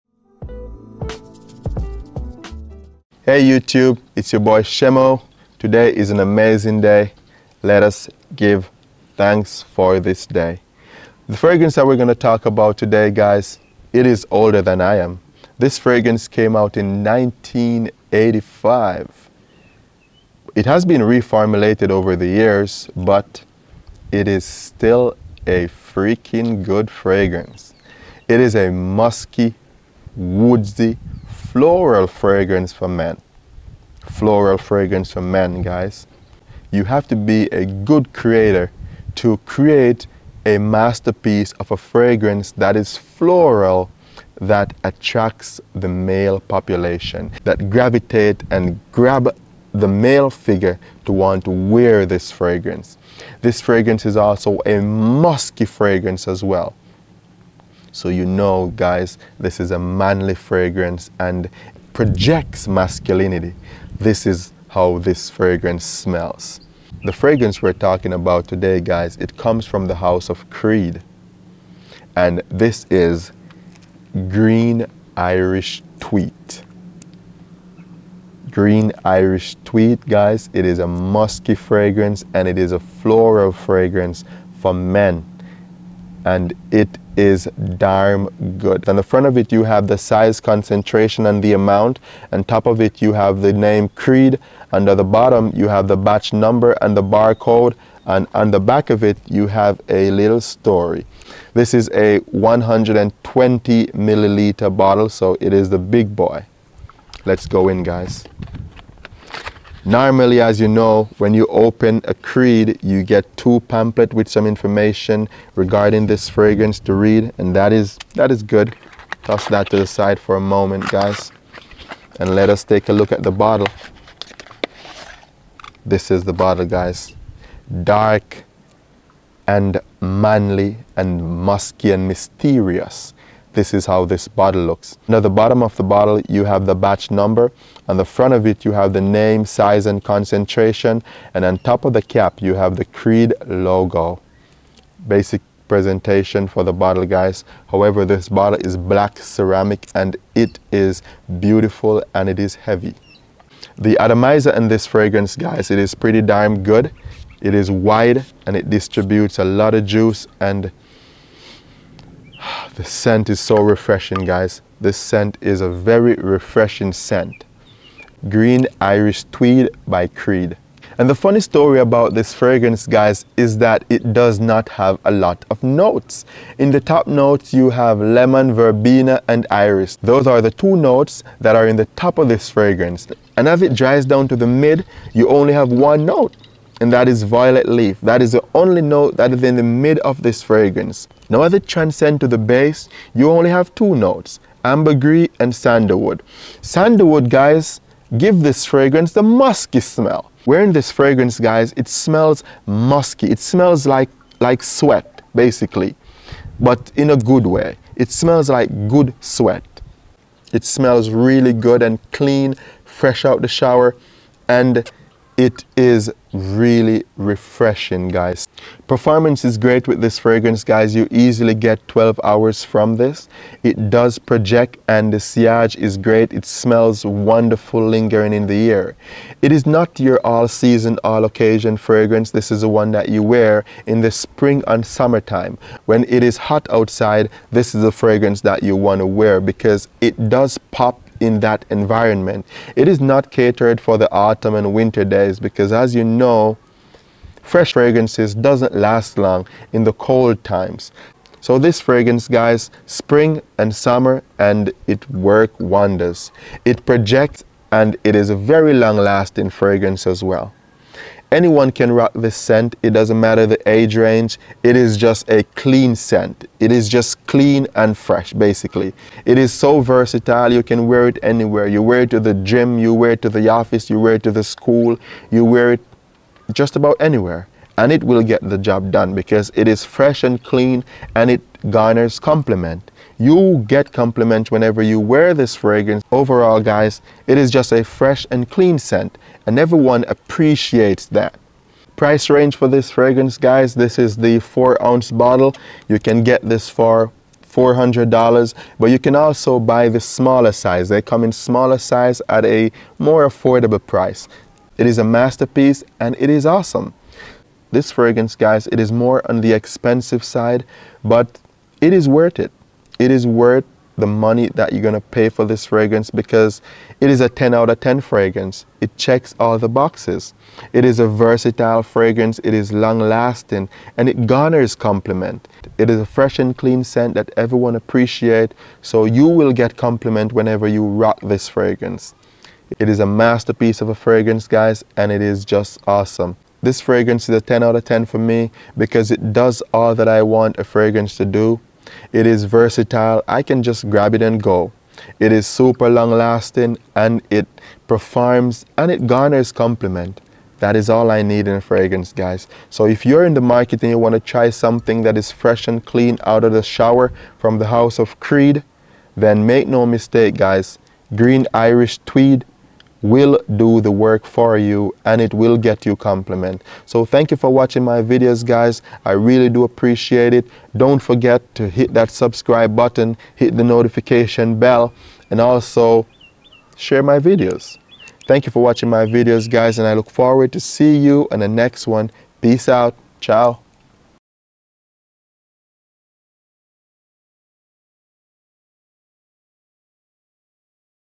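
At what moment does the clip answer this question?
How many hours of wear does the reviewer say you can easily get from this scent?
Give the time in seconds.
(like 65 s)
221 s.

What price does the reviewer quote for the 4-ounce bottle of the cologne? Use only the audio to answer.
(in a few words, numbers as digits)
$400.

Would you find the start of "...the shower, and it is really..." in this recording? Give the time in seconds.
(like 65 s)
213 s.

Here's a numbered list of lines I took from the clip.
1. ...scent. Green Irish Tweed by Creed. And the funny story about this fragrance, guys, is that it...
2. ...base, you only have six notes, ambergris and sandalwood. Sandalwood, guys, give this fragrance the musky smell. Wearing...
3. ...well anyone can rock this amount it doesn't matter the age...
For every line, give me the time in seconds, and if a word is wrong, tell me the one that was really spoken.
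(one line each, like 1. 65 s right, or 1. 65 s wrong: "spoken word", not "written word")
1. 166 s right
2. 192 s wrong: "two", not "six"
3. 260 s wrong: "scent", not "amount".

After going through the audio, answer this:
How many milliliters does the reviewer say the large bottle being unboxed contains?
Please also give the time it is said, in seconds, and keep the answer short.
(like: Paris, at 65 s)
120, at 102 s.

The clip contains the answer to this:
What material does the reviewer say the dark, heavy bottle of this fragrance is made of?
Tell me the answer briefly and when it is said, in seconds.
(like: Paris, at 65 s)
Black ceramic, at 148 s.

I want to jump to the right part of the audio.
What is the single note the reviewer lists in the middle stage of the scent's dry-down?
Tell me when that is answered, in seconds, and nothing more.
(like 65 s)
187 s.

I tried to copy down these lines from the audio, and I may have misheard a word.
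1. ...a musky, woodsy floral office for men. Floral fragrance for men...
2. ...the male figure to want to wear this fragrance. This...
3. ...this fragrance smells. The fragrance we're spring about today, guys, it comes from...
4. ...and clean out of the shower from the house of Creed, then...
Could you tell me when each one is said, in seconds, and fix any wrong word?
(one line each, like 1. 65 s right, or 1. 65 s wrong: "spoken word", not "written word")
1. 28 s wrong: "fragrance", not "office"
2. 49 s right
3. 64 s wrong: "talking", not "spring"
4. 355 s right.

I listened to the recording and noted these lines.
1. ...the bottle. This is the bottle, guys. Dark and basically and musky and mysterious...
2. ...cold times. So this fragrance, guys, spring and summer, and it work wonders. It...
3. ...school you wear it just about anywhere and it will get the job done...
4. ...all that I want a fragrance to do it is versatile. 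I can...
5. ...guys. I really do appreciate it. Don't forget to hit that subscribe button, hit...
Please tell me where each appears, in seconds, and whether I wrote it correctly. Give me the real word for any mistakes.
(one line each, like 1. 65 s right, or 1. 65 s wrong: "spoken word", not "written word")
1. 123 s wrong: "manly", not "basically"
2. 249 s right
3. 274 s right
4. 339 s right
5. 368 s right.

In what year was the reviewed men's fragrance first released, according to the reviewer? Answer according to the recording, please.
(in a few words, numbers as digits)
1985.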